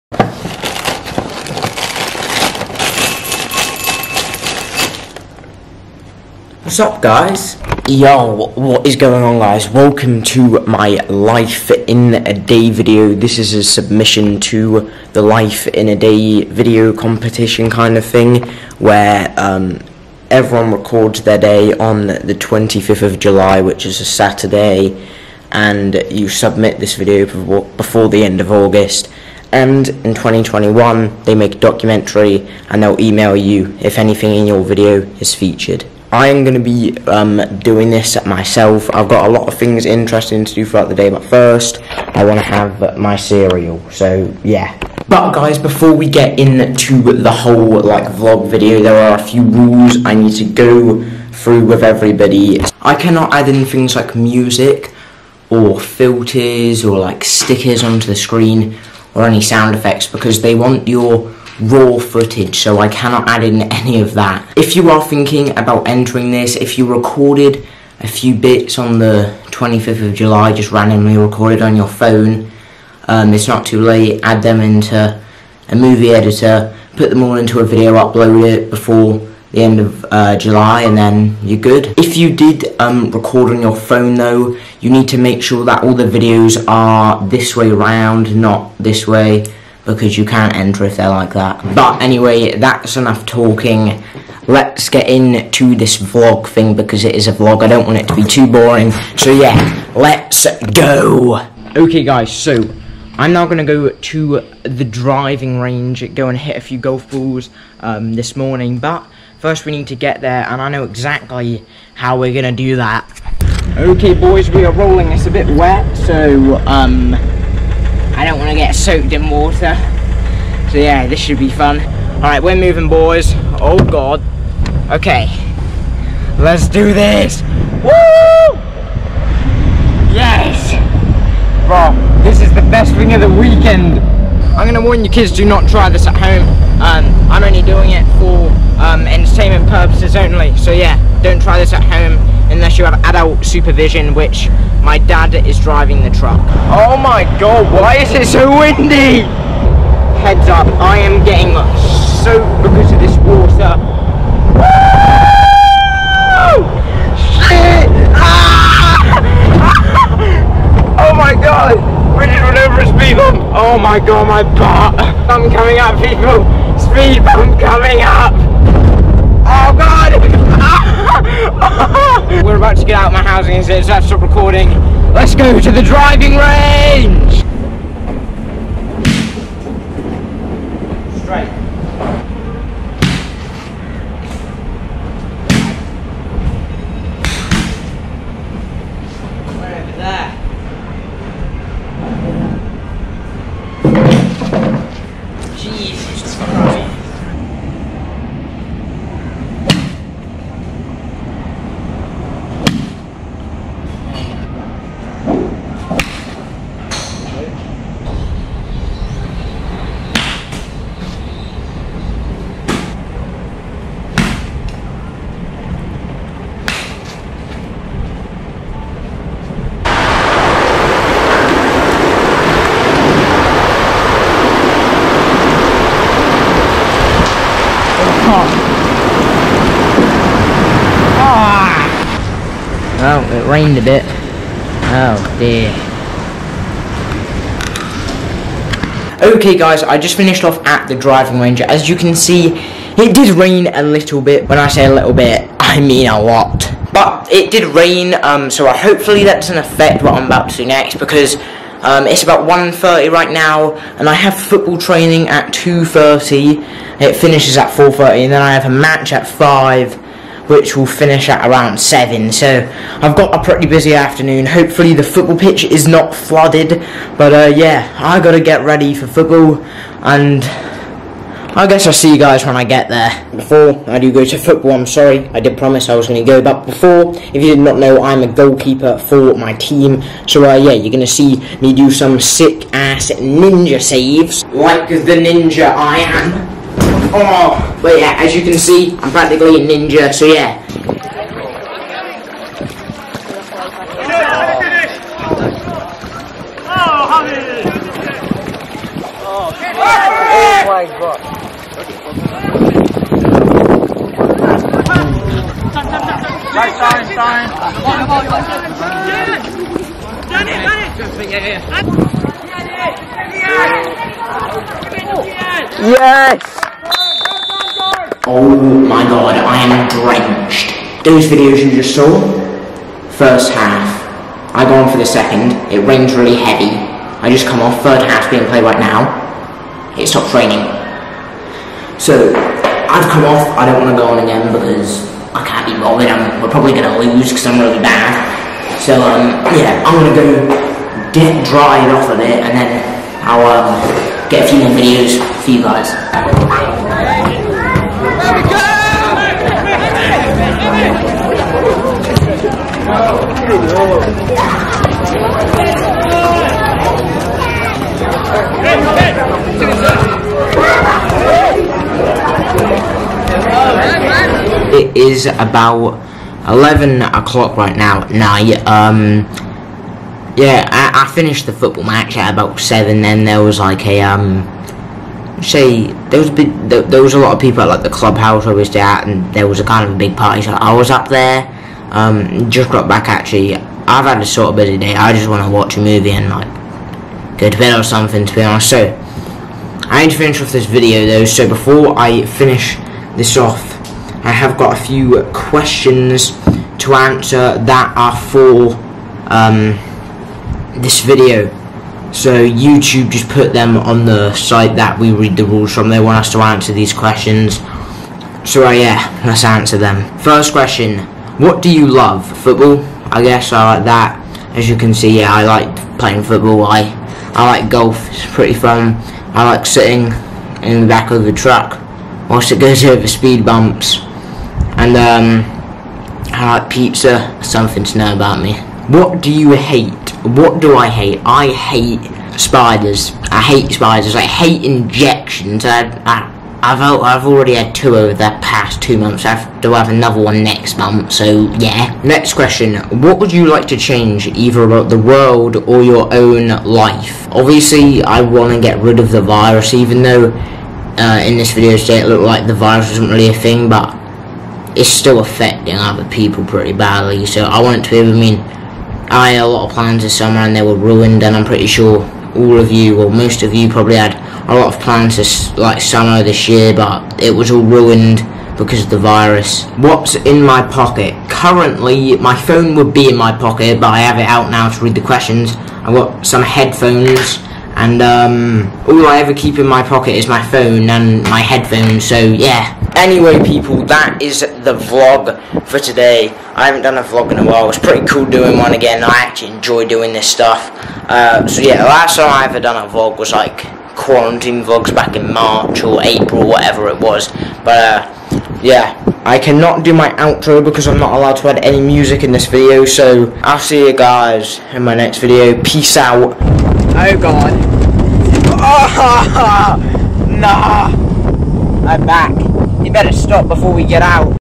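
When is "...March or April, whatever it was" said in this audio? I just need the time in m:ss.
8:15.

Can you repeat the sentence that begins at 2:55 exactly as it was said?
Let's go to the driving range!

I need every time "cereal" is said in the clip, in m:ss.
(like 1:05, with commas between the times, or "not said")
0:43.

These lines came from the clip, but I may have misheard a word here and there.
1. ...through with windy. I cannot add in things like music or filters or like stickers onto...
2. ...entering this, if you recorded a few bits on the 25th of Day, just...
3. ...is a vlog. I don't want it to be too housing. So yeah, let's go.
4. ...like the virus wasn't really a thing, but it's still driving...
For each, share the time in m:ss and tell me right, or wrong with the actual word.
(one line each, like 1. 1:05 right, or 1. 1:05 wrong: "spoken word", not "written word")
1. 0:51 wrong: "everybody", not "windy"
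2. 1:05 wrong: "July", not "Day"
3. 1:37 wrong: "boring", not "housing"
4. 7:32 wrong: "affecting", not "driving".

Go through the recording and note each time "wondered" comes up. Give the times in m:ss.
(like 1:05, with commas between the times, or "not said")
not said.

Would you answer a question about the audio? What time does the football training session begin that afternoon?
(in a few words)
2.30.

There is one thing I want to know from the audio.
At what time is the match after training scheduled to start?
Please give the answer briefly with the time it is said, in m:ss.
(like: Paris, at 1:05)
5, at 4:19.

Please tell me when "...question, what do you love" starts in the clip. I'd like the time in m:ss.
6:50.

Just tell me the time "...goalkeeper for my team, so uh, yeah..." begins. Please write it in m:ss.
4:38.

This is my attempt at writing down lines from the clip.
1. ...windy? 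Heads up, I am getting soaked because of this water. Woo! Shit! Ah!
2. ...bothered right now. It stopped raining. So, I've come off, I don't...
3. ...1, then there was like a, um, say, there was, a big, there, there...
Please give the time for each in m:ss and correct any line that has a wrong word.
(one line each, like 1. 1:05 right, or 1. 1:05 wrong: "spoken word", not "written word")
1. 2:28 right
2. 5:28 wrong: "played", not "bothered"
3. 6:12 wrong: "7", not "1".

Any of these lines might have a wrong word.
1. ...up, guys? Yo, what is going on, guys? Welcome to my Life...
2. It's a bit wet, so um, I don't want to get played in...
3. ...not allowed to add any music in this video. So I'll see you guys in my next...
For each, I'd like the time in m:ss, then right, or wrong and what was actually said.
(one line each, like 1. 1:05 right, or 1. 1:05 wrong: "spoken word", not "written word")
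1. 0:06 right
2. 1:55 wrong: "soaked", not "played"
3. 8:20 right.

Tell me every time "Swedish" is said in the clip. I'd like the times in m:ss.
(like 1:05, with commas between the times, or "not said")
not said.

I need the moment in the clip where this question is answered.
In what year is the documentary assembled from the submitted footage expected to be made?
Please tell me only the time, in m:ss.
0:30.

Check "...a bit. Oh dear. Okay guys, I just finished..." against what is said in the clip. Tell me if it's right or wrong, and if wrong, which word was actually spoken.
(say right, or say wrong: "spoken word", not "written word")
right.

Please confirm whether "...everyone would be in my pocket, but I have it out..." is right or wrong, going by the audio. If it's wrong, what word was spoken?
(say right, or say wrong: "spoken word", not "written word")
wrong: "phone", not "everyone".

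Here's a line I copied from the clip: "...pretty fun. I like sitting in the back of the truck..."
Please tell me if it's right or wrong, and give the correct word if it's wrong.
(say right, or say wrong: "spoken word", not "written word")
right.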